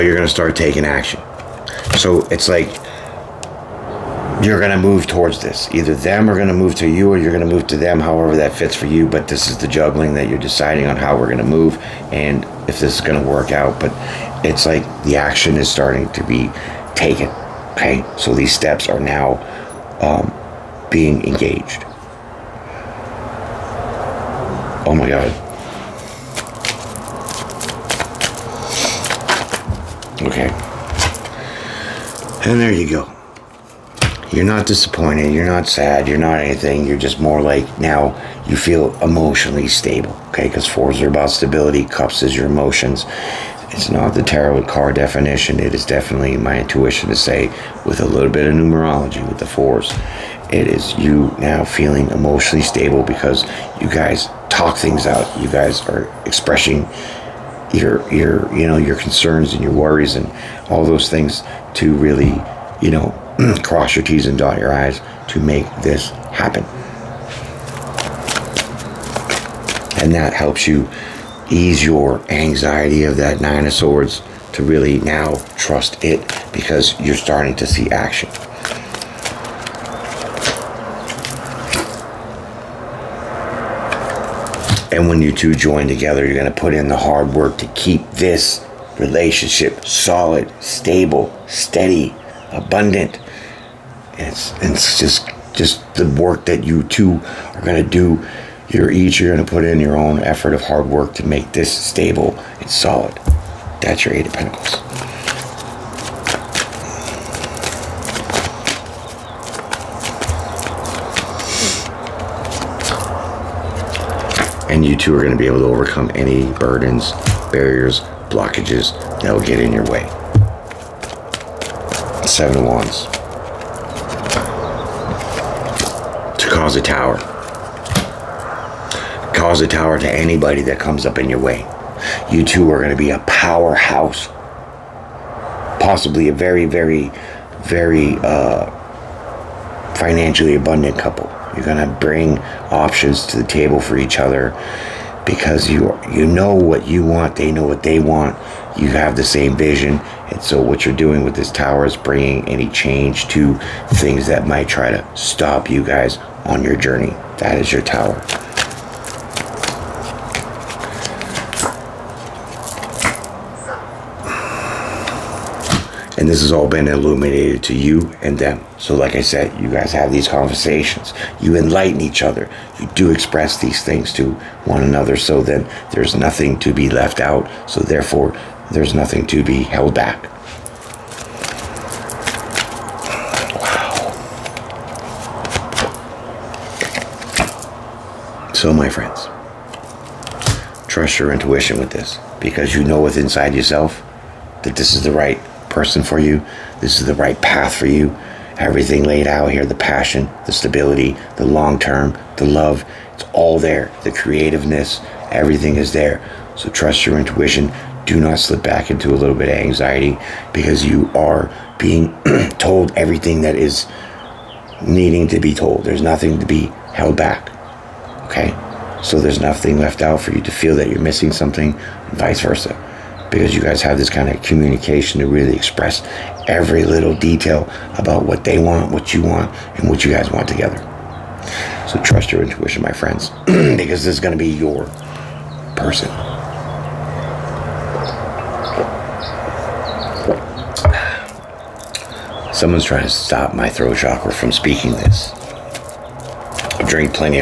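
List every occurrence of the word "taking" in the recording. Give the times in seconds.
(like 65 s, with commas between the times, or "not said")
0 s.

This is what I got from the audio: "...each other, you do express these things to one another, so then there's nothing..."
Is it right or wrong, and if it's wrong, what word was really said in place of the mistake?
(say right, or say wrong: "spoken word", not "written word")
right.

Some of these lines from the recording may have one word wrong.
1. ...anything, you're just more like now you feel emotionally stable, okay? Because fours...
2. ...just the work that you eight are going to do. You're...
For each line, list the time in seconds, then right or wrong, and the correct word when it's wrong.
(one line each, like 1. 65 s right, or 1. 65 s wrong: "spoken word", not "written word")
1. 36 s right
2. 95 s wrong: "two", not "eight".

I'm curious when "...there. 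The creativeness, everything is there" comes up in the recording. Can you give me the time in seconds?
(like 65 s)
203 s.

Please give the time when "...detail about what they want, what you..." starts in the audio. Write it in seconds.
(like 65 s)
227 s.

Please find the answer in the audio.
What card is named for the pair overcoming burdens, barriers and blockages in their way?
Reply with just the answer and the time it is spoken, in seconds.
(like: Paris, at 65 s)
Seven of Wands, at 122 s.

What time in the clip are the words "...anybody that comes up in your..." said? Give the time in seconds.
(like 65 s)
130 s.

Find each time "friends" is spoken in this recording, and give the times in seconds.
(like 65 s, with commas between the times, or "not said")
188 s, 232 s.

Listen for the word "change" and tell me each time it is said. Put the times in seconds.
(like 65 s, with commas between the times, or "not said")
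152 s.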